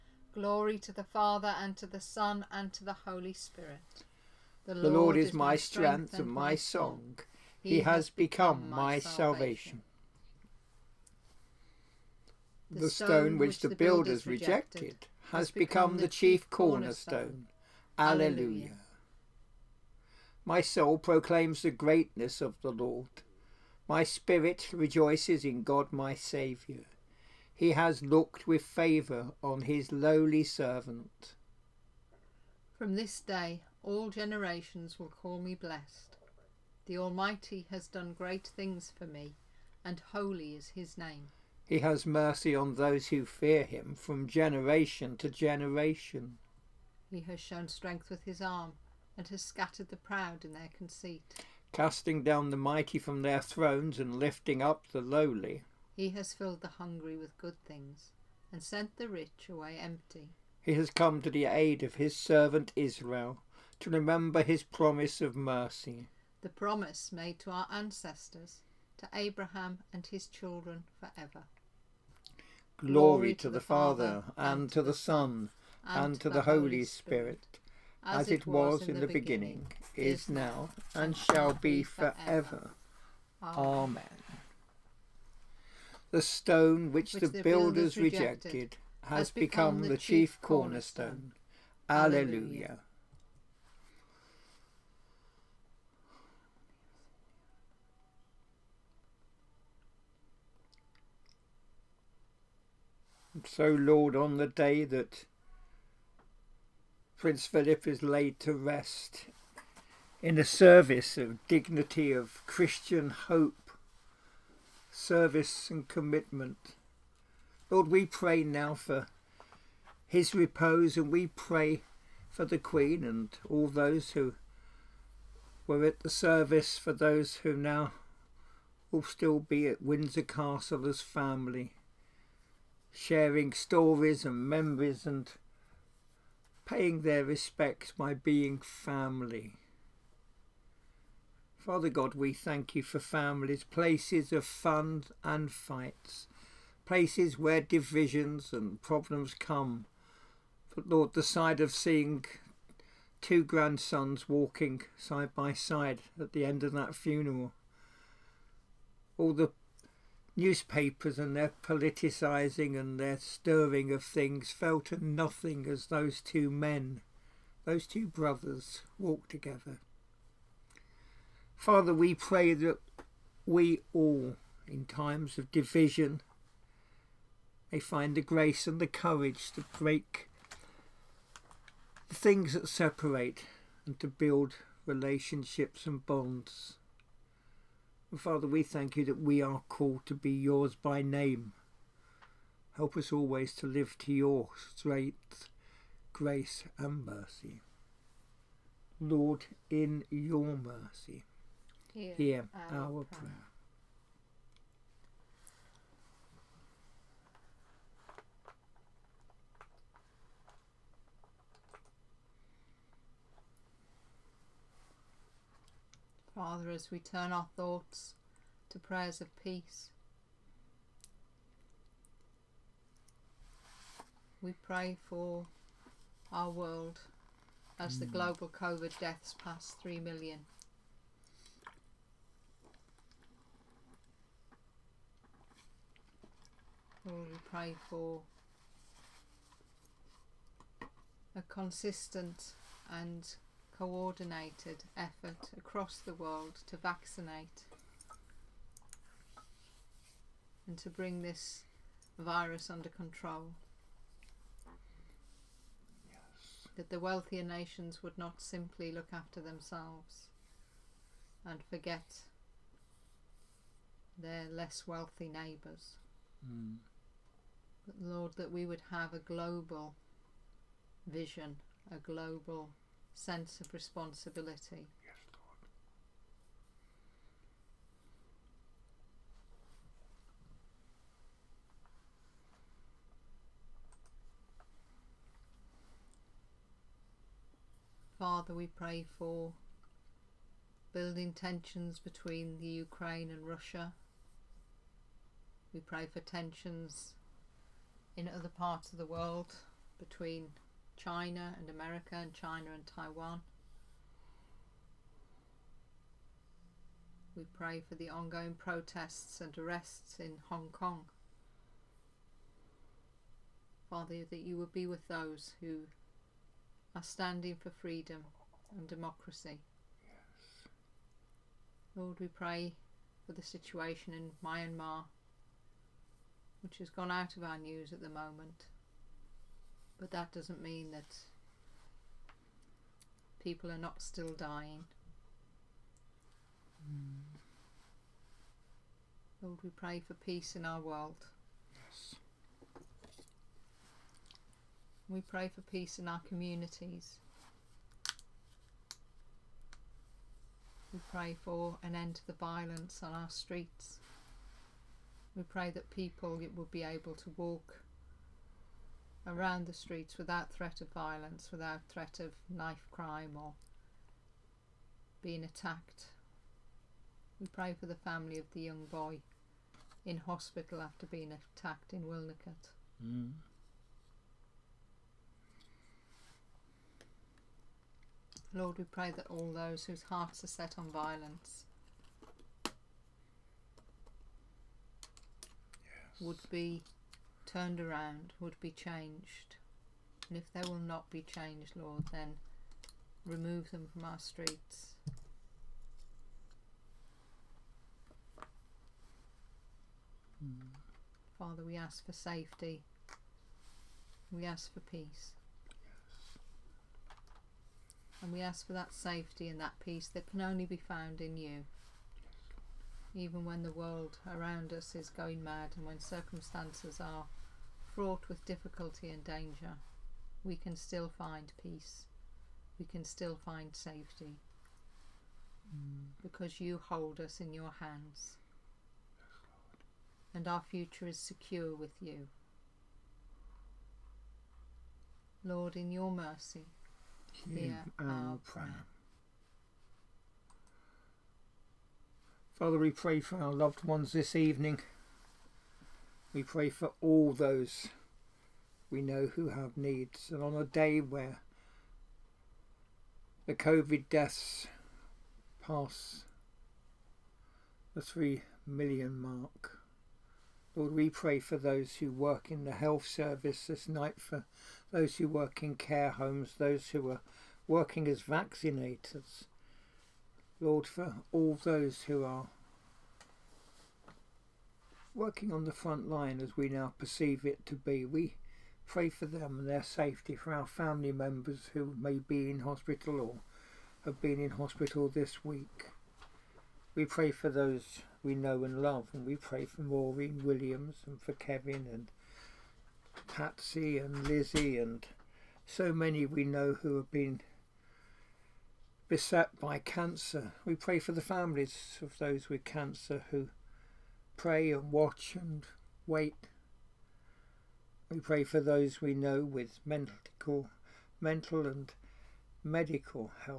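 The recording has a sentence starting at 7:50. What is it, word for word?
Lord, for all those who are working on the front line as we now perceive it to be.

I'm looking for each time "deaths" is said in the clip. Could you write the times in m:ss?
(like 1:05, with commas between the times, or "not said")
3:49, 7:34.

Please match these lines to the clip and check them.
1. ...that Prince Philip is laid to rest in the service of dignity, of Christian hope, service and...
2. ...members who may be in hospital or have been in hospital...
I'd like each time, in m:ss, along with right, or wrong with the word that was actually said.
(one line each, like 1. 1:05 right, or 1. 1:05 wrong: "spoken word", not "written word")
1. 1:44 right
2. 8:01 right.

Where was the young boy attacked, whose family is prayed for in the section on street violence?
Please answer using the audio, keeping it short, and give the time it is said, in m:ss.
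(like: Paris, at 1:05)
Wilnicott, at 6:12.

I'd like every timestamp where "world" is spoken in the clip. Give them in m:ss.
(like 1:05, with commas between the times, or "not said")
3:46, 4:06, 4:59, 5:40, 6:53.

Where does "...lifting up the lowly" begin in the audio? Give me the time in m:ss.
0:54.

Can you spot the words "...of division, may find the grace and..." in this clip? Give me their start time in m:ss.
2:55.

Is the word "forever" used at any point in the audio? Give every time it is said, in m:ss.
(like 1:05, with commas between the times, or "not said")
1:10, 1:21.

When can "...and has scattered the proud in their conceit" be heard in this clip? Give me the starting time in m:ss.
0:49.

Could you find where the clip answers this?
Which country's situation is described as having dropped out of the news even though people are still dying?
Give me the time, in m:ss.
5:24.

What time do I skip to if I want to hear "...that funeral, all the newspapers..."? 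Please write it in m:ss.
2:36.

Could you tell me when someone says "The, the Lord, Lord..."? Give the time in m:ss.
0:04.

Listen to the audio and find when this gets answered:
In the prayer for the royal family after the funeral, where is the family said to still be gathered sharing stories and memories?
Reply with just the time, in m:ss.
2:09.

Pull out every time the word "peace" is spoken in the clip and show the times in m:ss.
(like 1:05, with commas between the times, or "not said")
3:39, 5:40, 5:45, 6:44, 6:49, 7:01.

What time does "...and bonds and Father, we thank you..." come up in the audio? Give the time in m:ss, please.
3:05.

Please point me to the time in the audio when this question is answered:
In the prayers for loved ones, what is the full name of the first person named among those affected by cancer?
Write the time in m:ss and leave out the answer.
8:09.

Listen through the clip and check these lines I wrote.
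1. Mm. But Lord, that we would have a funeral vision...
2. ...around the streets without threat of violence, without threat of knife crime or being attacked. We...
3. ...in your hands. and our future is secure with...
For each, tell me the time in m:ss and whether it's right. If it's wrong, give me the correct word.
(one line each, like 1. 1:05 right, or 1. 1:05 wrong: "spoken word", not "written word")
1. 4:26 wrong: "global", not "funeral"
2. 5:59 right
3. 7:07 right.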